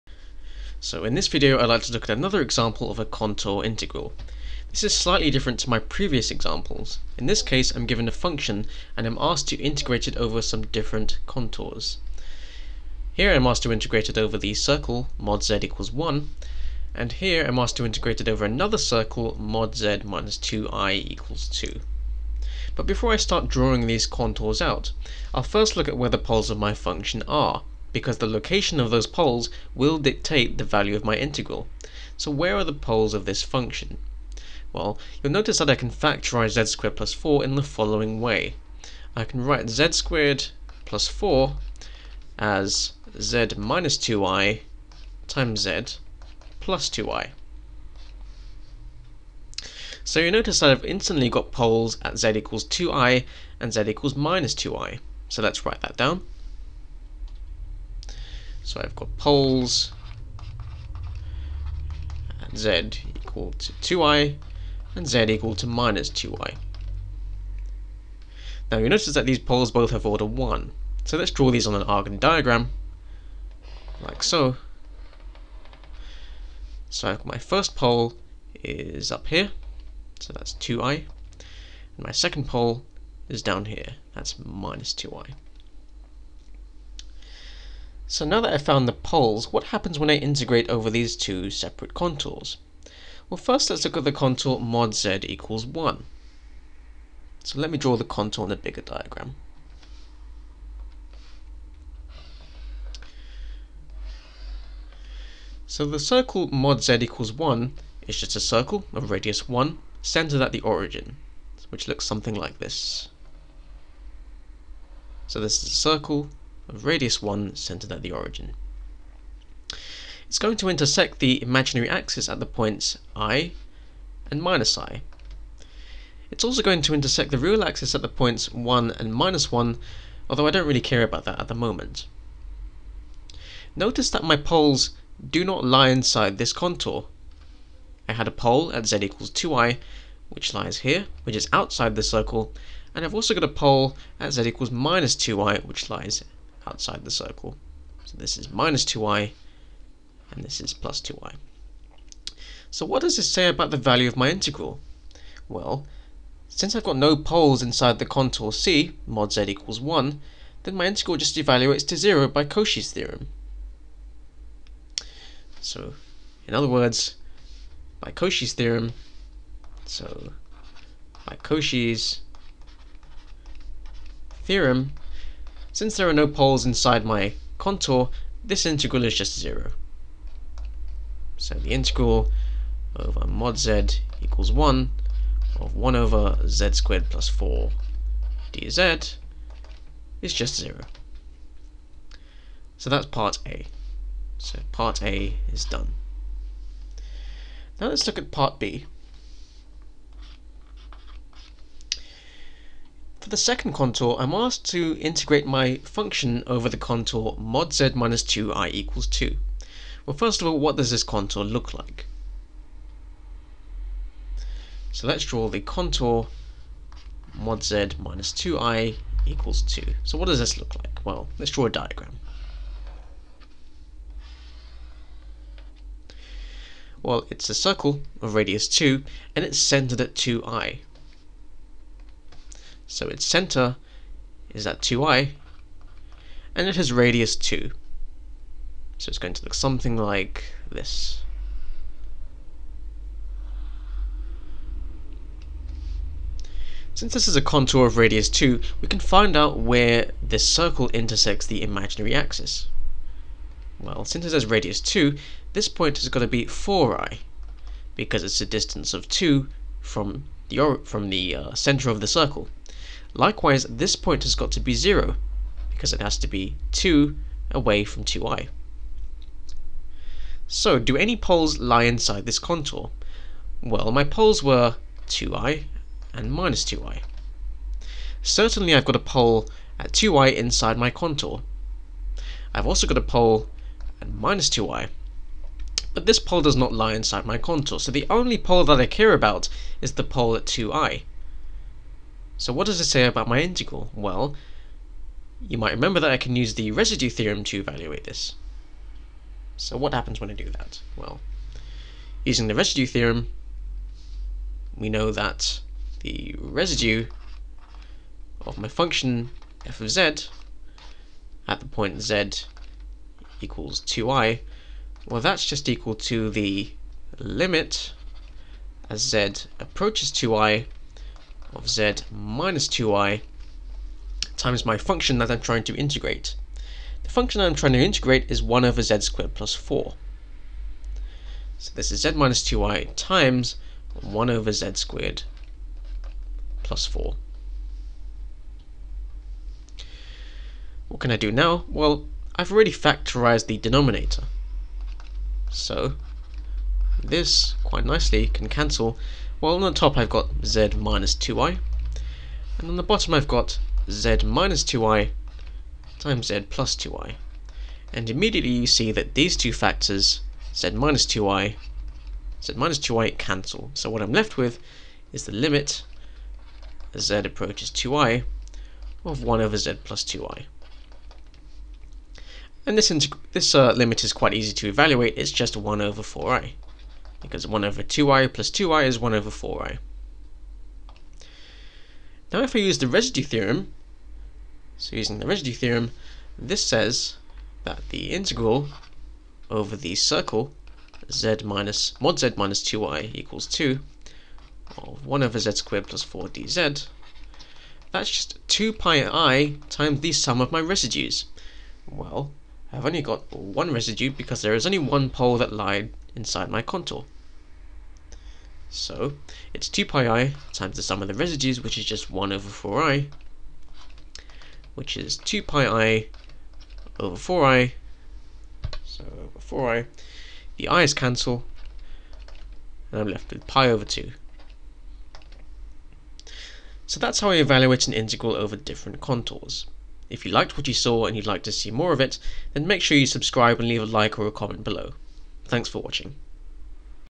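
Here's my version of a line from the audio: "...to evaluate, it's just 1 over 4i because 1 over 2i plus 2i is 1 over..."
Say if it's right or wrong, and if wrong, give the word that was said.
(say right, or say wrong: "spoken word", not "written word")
right.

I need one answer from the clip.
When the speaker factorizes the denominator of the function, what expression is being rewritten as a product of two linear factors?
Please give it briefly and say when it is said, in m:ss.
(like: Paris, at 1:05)
z squared plus 4, at 0:39.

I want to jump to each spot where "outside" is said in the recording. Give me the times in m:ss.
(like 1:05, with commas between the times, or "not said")
2:21, 2:26.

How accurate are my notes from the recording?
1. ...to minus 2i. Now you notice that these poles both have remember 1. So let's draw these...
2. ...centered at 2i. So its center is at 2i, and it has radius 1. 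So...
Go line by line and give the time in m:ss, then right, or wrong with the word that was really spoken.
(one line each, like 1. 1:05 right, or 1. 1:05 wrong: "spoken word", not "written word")
1. 1:05 wrong: "order", not "remember"
2. 3:49 wrong: "2", not "1".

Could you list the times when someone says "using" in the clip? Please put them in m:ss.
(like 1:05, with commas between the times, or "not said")
5:02, 6:24.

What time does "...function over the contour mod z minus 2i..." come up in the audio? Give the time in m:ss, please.
3:25.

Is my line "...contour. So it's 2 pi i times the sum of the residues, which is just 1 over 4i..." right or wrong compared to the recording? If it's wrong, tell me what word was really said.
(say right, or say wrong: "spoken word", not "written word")
right.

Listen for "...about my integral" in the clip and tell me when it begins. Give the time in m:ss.
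4:53.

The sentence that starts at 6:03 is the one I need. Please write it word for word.
So what I'm left with is the limit as z approaches 2i of 1 over z plus 2i.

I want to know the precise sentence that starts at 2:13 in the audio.
Notice that my poles do not lie inside this contour.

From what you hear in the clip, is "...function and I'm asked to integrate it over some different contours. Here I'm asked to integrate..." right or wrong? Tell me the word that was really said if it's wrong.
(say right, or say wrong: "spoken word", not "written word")
right.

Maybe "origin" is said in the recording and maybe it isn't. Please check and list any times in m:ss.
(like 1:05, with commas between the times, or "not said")
1:50, 1:58.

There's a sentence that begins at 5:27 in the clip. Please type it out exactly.
The function I'm trying to integrate is 1 over z squared plus 4.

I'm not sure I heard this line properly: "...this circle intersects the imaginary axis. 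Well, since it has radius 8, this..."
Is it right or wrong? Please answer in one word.
wrong.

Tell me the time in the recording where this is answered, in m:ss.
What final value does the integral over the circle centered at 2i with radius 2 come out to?
7:03.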